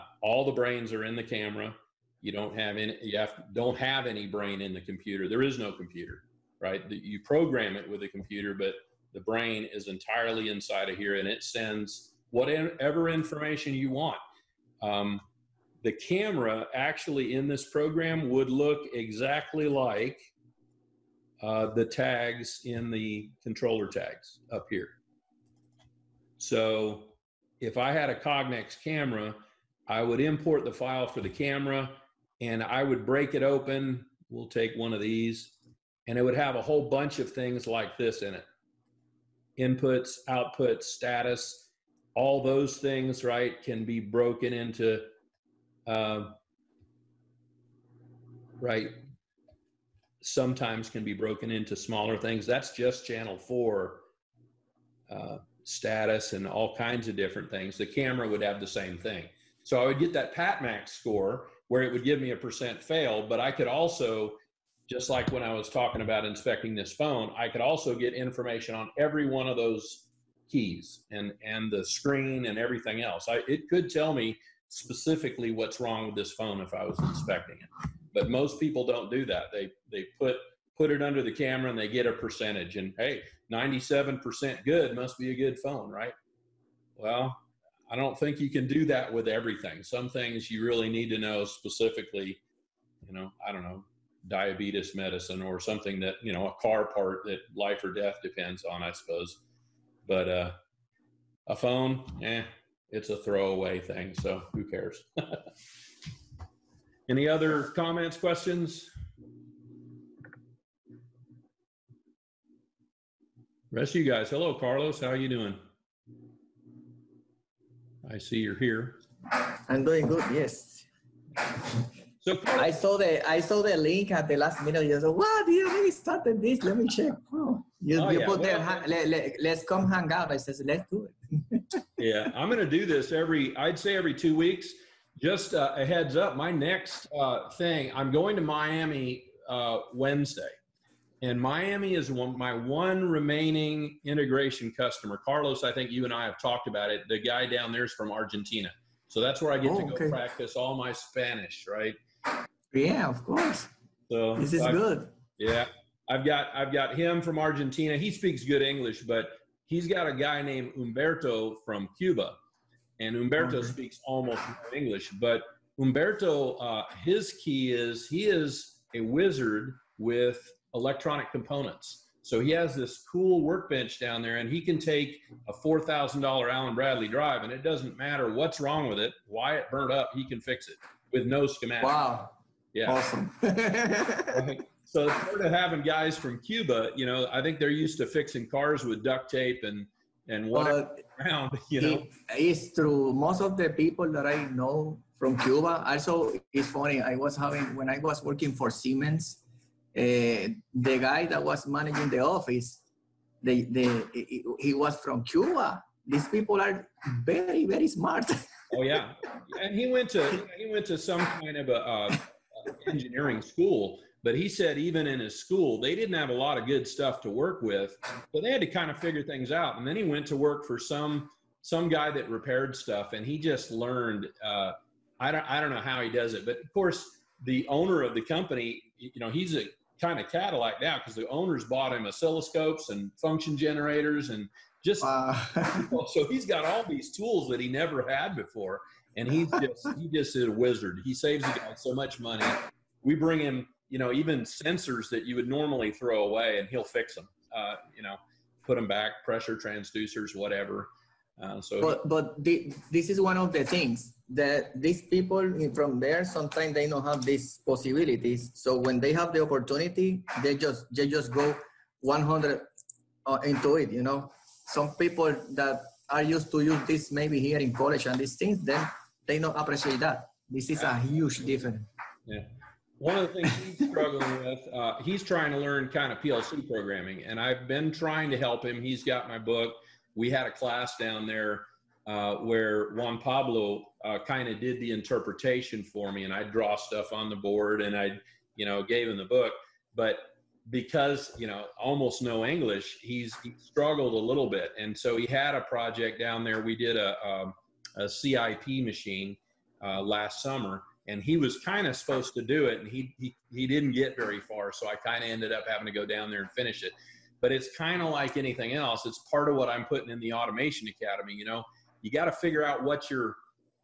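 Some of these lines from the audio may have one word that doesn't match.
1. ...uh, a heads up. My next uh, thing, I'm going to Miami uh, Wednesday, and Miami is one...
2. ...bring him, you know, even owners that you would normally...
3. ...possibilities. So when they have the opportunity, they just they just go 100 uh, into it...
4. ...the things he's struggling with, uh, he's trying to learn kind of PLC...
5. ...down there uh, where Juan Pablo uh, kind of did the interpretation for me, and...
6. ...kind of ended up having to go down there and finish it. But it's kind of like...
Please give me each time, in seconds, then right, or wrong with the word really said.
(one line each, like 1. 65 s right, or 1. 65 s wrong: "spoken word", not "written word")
1. 135 s right
2. 243 s wrong: "sensors", not "owners"
3. 257 s right
4. 273 s right
5. 280 s right
6. 304 s right.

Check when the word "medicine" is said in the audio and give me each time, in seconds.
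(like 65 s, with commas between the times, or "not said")
94 s.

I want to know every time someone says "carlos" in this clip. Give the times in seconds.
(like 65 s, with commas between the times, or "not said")
114 s, 145 s.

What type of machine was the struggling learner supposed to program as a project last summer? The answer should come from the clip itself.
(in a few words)
CIP machine.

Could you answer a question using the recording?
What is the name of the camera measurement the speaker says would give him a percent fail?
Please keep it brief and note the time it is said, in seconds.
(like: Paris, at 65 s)
PatMax score, at 60 s.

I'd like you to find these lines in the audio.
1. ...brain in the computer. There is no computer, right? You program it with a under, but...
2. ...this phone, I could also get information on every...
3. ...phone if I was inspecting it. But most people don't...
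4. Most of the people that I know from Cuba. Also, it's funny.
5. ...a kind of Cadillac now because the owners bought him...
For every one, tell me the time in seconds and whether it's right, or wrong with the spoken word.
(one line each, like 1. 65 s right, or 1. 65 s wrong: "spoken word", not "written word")
1. 4 s wrong: "computer", not "under"
2. 66 s right
3. 76 s right
4. 193 s right
5. 229 s right.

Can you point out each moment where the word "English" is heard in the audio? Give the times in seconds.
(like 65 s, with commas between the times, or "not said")
158 s, 164 s, 292 s.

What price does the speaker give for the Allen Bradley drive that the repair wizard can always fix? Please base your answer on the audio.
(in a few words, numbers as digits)
$4,000.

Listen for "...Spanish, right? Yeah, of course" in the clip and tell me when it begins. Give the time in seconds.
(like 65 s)
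150 s.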